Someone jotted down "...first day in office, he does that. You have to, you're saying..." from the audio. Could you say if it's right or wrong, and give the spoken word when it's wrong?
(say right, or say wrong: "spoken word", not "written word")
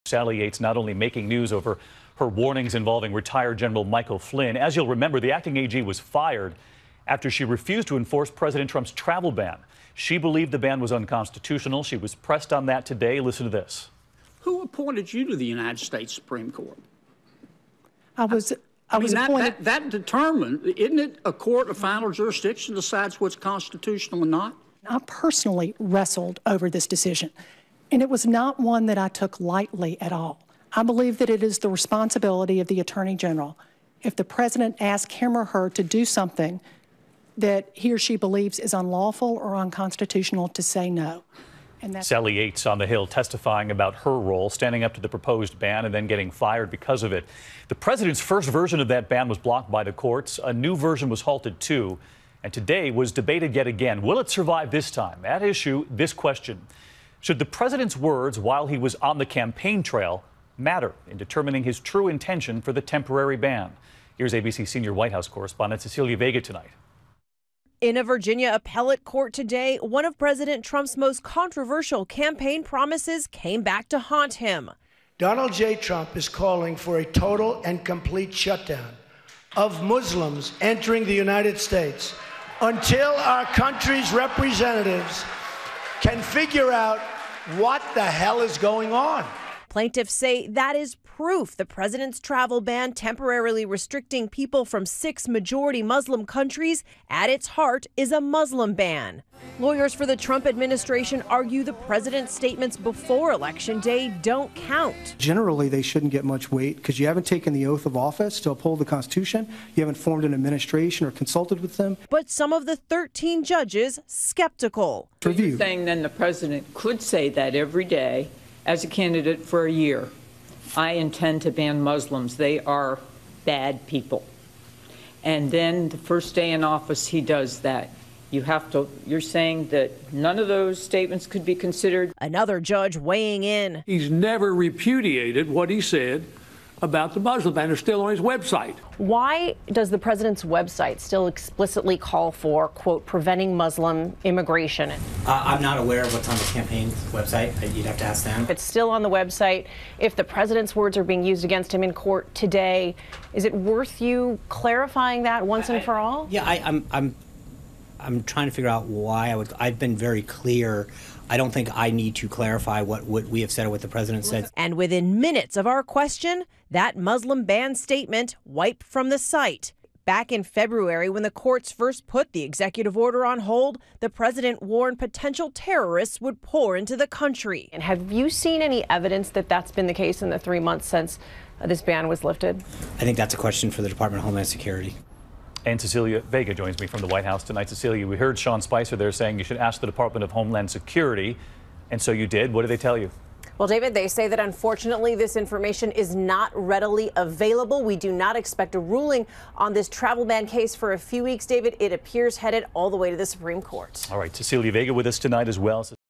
right.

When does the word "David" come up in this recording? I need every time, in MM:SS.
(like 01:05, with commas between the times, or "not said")
03:13, 03:21.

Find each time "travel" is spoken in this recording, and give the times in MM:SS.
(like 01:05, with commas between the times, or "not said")
00:08, 01:32, 03:19.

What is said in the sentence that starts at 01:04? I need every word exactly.
Here's ABC senior White House correspondent Cecilia Vega tonight.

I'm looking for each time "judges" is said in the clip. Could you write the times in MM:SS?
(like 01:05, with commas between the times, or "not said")
01:53, 02:12.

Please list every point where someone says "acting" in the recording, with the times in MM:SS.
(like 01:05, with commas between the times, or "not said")
00:05.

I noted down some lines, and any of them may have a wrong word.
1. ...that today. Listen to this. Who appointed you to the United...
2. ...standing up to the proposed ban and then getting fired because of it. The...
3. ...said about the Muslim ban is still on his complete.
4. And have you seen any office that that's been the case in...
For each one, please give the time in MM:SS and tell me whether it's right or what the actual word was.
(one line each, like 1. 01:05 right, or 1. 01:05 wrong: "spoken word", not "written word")
1. 00:12 right
2. 00:44 right
3. 02:15 wrong: "website", not "complete"
4. 02:57 wrong: "evidence", not "office".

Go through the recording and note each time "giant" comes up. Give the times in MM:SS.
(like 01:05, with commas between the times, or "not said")
not said.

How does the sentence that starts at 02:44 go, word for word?
And within minutes of our question, that Muslim ban statement wiped from the site.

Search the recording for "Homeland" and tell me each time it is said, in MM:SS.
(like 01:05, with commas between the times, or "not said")
03:04, 03:10.